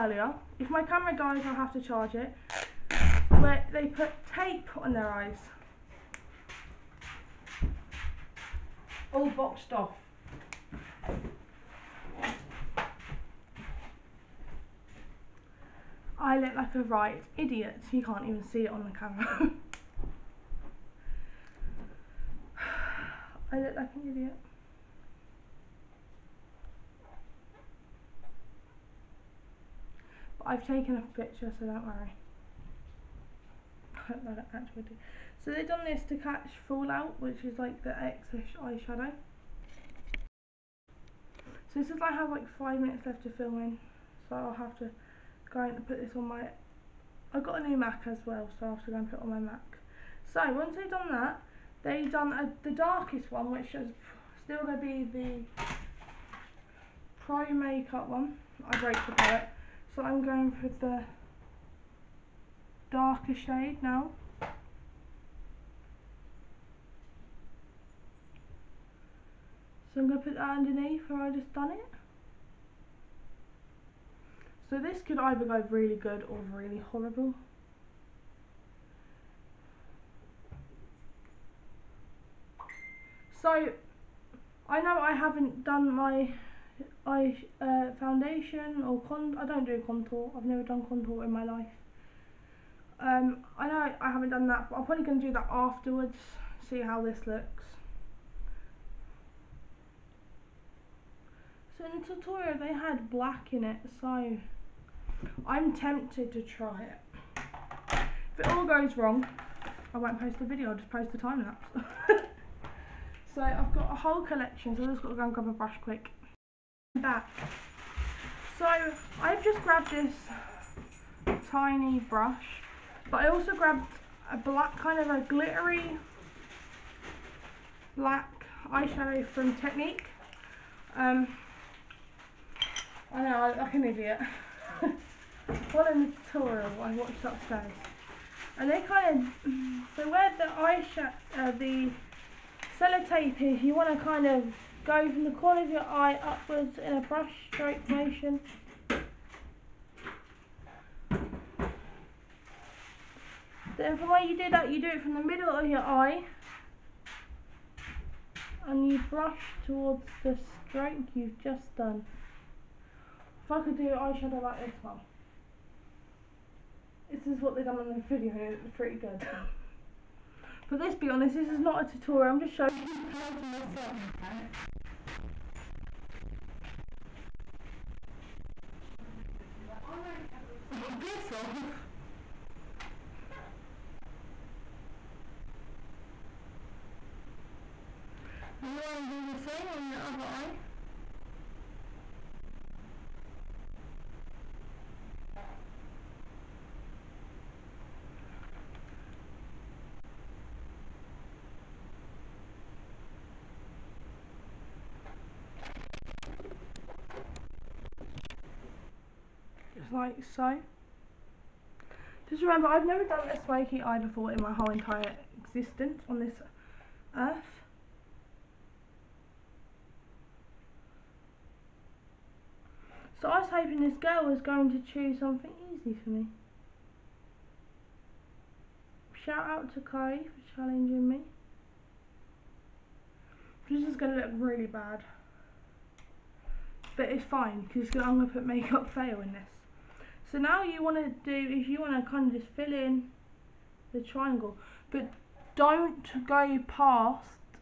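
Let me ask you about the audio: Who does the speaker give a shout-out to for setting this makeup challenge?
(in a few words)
Kai.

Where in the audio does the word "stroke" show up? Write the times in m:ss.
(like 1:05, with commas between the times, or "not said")
2:27, 2:40.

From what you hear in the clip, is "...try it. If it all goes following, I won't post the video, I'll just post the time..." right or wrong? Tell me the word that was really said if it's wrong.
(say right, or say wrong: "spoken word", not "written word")
wrong: "wrong", not "following".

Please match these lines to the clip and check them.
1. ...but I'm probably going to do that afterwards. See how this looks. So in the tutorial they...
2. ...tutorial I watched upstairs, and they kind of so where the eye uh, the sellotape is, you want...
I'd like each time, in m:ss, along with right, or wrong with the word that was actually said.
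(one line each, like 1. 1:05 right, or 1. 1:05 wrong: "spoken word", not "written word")
1. 1:34 right
2. 2:16 right.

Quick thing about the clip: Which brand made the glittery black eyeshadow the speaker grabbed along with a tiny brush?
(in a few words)
Technique.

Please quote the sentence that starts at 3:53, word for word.
This is going to look really bad.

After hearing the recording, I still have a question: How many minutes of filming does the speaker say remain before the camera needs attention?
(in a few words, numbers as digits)
5.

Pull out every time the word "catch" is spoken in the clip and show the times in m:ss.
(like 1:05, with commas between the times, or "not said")
0:36.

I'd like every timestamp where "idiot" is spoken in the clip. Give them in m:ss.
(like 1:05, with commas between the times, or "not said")
0:17, 0:24, 2:13.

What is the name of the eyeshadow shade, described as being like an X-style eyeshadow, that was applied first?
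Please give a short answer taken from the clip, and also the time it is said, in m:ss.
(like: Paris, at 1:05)
Fallout, at 0:36.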